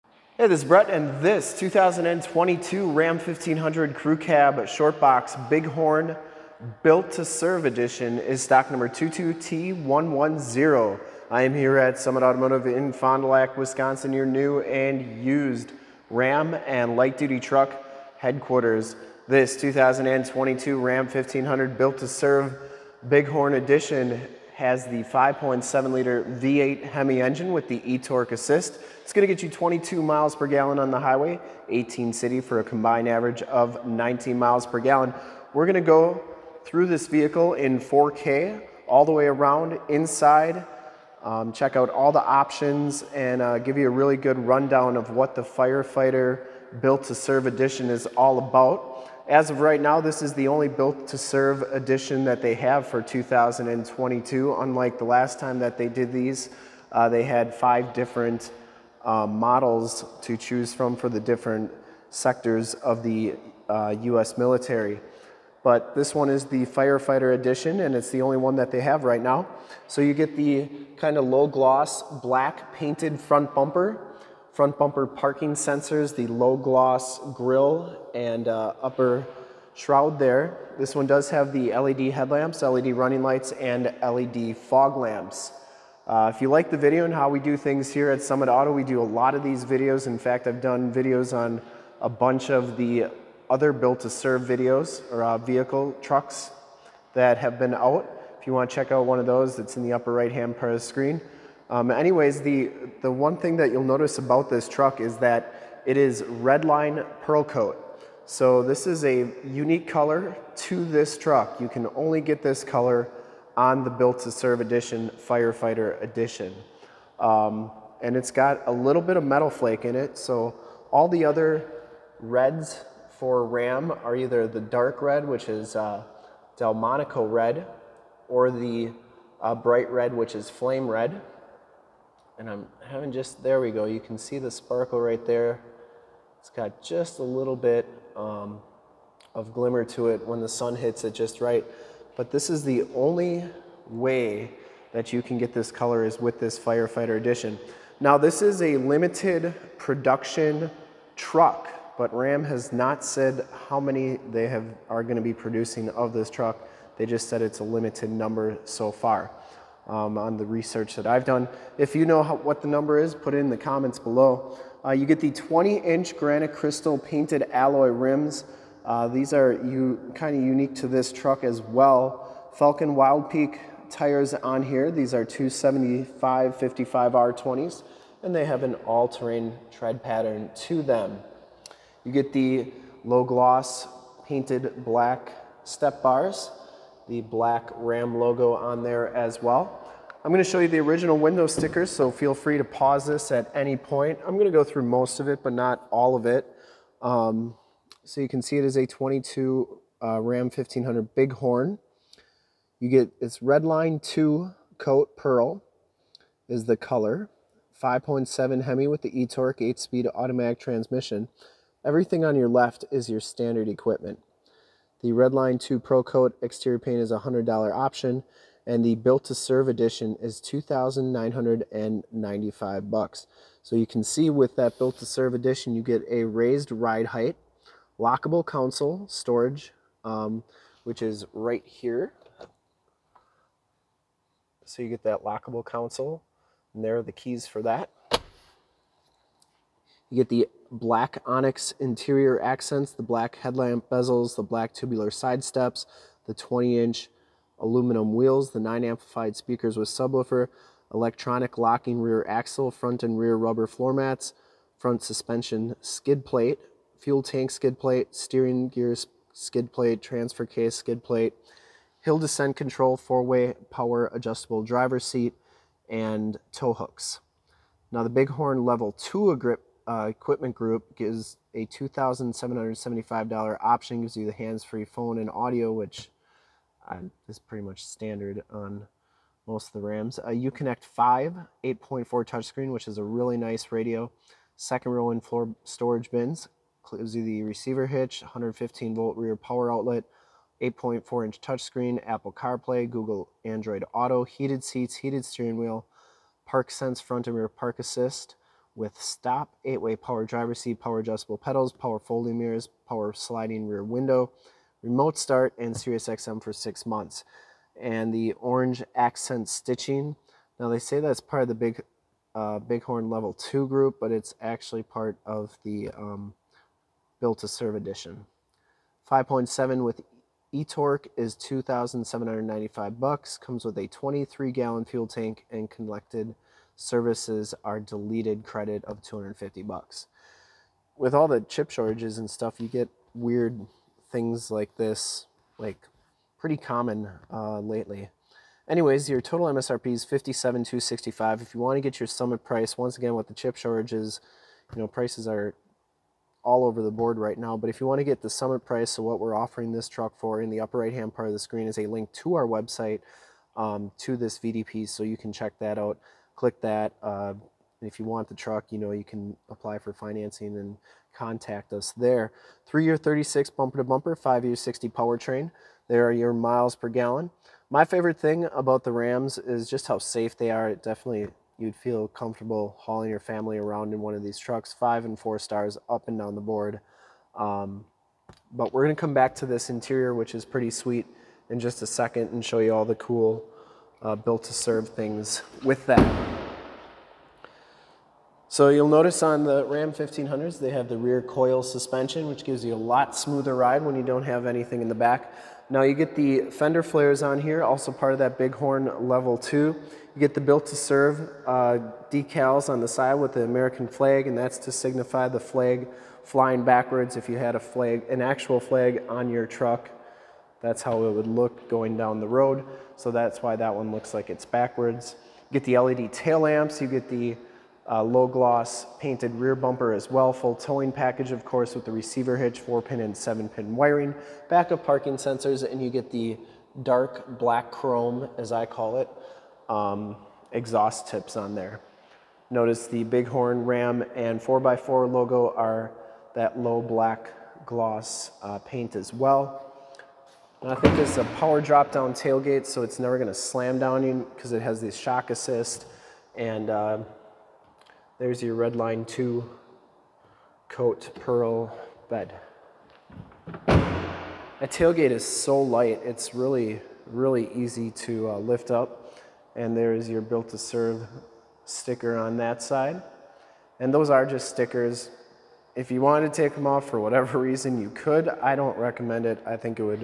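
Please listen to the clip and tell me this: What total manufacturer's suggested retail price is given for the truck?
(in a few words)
$57,265.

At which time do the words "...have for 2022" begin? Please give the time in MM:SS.
00:52.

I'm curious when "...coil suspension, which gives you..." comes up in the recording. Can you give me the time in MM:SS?
06:31.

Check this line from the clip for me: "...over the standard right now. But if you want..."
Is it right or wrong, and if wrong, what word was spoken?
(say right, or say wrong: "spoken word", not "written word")
wrong: "board", not "standard".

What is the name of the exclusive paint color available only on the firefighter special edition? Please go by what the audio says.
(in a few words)
Redline Pearl Coat.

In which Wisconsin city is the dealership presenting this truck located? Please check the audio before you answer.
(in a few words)
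Fond du Lac.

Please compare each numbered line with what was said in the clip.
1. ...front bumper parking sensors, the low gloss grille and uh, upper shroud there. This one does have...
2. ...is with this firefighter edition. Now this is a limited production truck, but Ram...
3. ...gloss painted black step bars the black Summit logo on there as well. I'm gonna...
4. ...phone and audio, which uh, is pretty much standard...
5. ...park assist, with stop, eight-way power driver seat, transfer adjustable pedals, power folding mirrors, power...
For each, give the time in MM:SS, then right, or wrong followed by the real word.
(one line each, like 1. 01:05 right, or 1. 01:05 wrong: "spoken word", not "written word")
1. 01:14 right
2. 02:26 right
3. 03:03 wrong: "RAM", not "Summit"
4. 04:34 right
5. 04:57 wrong: "power", not "transfer".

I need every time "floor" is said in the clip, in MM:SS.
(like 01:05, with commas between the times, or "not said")
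04:13, 04:45.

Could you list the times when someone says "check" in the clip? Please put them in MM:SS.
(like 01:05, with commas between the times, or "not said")
00:41, 01:38, 05:55.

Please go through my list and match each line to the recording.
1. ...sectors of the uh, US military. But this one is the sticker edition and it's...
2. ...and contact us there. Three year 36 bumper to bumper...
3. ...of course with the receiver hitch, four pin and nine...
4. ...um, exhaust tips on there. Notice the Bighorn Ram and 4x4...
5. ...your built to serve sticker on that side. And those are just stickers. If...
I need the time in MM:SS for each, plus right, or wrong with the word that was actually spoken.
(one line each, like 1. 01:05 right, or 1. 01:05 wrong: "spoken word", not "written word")
1. 01:02 wrong: "firefighter", not "sticker"
2. 06:00 right
3. 07:01 wrong: "seven", not "nine"
4. 07:09 right
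5. 07:40 right.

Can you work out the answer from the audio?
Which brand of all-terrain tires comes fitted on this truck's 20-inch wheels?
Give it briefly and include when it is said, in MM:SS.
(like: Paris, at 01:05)
Falken Wild Peak, at 02:52.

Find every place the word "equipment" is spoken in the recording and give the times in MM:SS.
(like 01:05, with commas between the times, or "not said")
03:33, 04:30.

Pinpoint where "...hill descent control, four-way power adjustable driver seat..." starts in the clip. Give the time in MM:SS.
04:22.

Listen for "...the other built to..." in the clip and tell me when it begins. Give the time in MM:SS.
01:32.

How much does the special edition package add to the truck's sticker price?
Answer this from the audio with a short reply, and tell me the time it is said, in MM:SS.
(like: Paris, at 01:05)
$2,995, at 03:40.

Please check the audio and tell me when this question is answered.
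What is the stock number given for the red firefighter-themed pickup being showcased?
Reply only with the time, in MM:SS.
00:08.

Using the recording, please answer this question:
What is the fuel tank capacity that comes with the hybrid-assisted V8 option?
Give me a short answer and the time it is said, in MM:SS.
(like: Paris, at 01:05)
23 gallons, at 05:23.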